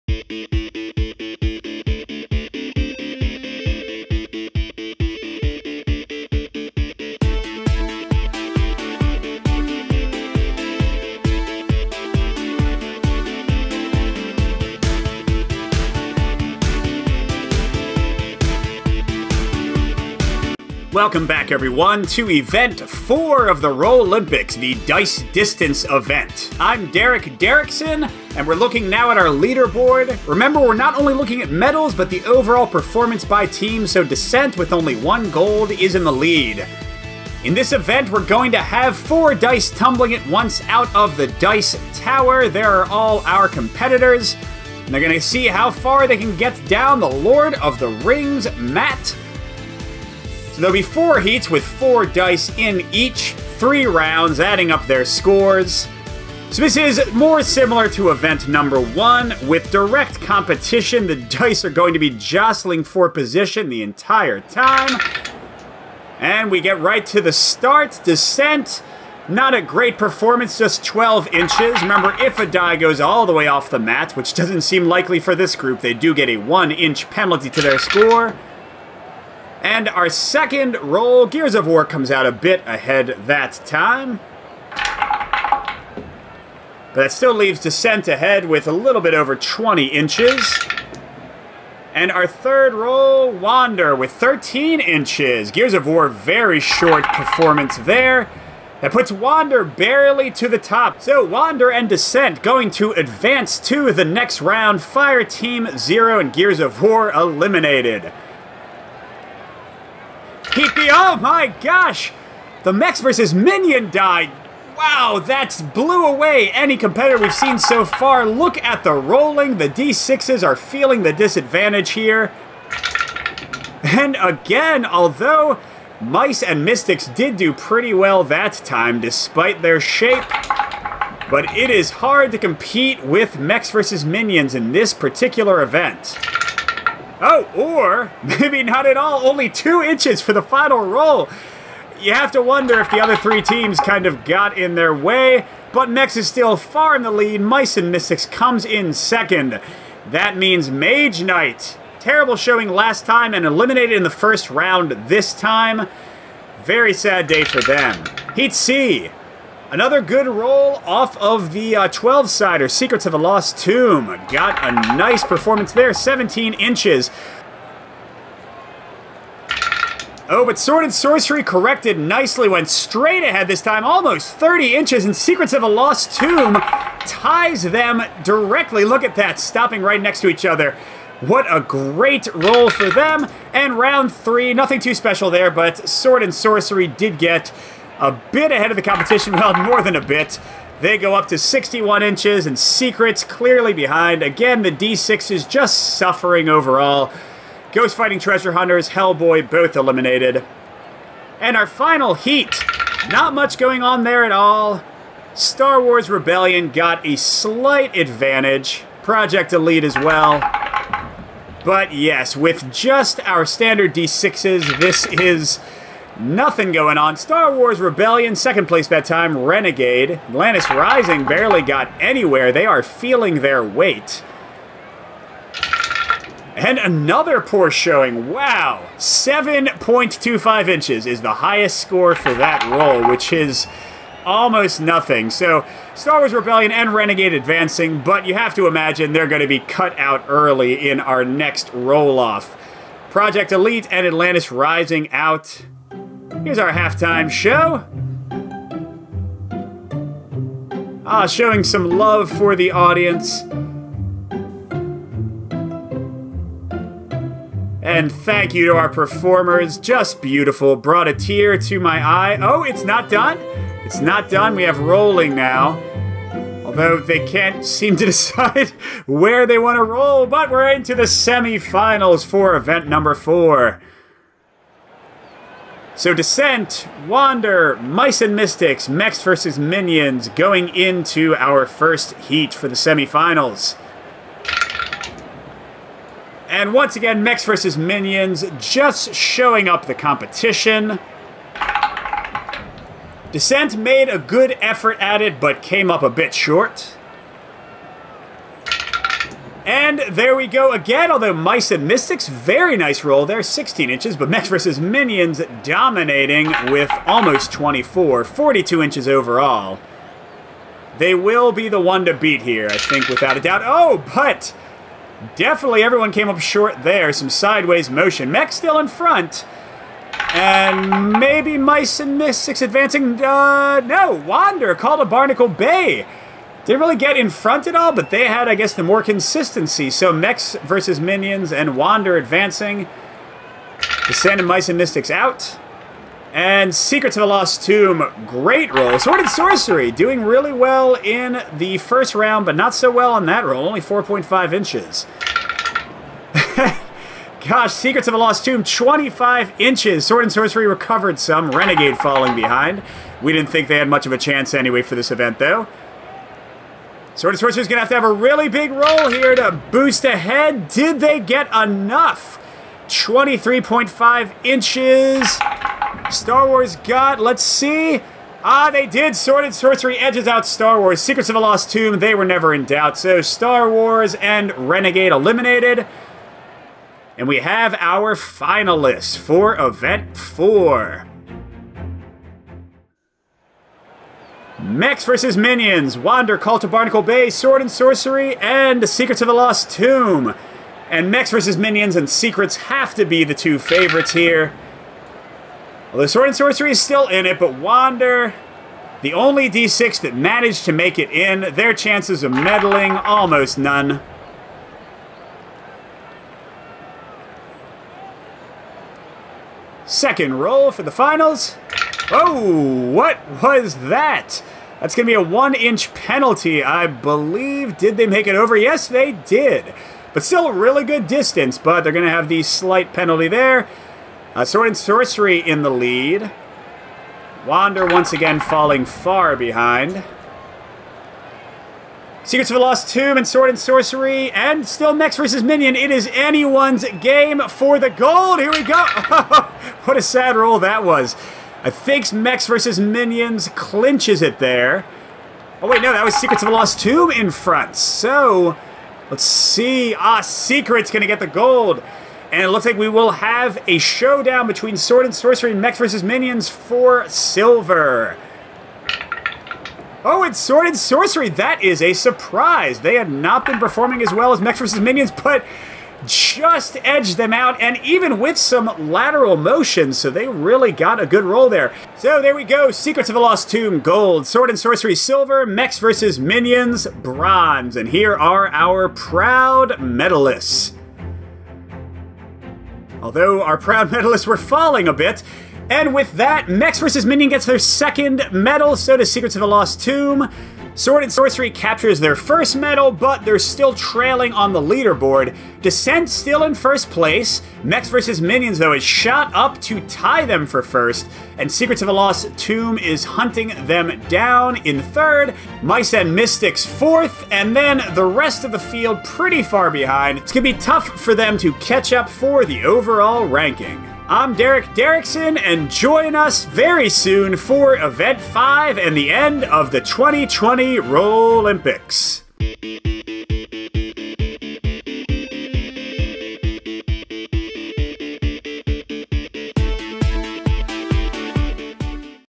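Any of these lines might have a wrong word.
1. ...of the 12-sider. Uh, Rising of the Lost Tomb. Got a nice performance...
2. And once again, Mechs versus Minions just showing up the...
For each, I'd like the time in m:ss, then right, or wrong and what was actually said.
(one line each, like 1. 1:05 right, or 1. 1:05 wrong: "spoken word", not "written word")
1. 2:41 wrong: "Secrets", not "Rising"
2. 4:46 right.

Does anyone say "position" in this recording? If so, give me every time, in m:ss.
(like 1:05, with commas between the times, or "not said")
1:03.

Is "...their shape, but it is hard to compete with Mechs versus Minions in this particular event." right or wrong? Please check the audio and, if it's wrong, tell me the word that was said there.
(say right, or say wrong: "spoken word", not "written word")
right.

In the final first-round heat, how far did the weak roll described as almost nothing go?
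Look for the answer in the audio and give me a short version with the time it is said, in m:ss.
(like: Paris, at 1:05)
7.25 inches, at 3:48.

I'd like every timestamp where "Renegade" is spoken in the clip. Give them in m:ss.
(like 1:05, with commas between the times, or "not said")
3:39, 3:56, 5:51, 6:14.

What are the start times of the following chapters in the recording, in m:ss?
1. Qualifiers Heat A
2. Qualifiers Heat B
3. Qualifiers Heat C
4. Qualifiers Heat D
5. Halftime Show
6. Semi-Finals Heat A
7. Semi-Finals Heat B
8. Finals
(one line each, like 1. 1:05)
1. 1:03
2. 1:49
3. 2:36
4. 3:21
5. 4:05
6. 4:34
7. 5:33
8. 6:23.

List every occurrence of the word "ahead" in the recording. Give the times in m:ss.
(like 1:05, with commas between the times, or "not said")
1:22, 1:28, 2:53, 3:08, 6:00.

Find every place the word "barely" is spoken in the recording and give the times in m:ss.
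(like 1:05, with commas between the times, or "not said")
1:39, 3:41.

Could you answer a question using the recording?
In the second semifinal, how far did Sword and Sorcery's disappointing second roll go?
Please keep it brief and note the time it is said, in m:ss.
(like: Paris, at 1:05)
4.5 inches, at 5:43.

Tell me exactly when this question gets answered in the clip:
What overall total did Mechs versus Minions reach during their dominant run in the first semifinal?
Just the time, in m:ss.
5:08.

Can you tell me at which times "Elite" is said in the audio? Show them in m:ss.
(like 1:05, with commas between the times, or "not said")
3:29, 4:03.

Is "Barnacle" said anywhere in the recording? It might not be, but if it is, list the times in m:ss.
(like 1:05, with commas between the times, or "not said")
5:25, 6:26.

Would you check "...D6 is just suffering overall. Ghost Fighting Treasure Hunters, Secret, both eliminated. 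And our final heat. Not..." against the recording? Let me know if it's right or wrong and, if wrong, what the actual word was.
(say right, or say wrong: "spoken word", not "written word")
wrong: "Hellboy", not "Secret".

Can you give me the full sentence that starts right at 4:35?
So Descent, Wander, Mice and Mystics, Mechs versus Minions going into our first heat for the semifinals.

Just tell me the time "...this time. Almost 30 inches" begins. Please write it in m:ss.
2:53.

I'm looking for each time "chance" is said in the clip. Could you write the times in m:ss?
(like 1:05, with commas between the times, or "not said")
5:54, 6:41.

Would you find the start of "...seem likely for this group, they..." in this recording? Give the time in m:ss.
1:14.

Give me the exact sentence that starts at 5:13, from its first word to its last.
Oh, but definitely everyone came up short there.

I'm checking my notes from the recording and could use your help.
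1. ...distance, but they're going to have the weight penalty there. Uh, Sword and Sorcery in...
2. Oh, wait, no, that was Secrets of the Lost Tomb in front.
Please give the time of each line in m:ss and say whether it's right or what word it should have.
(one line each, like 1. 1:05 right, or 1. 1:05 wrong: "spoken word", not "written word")
1. 7:01 wrong: "slight", not "weight"
2. 7:25 right.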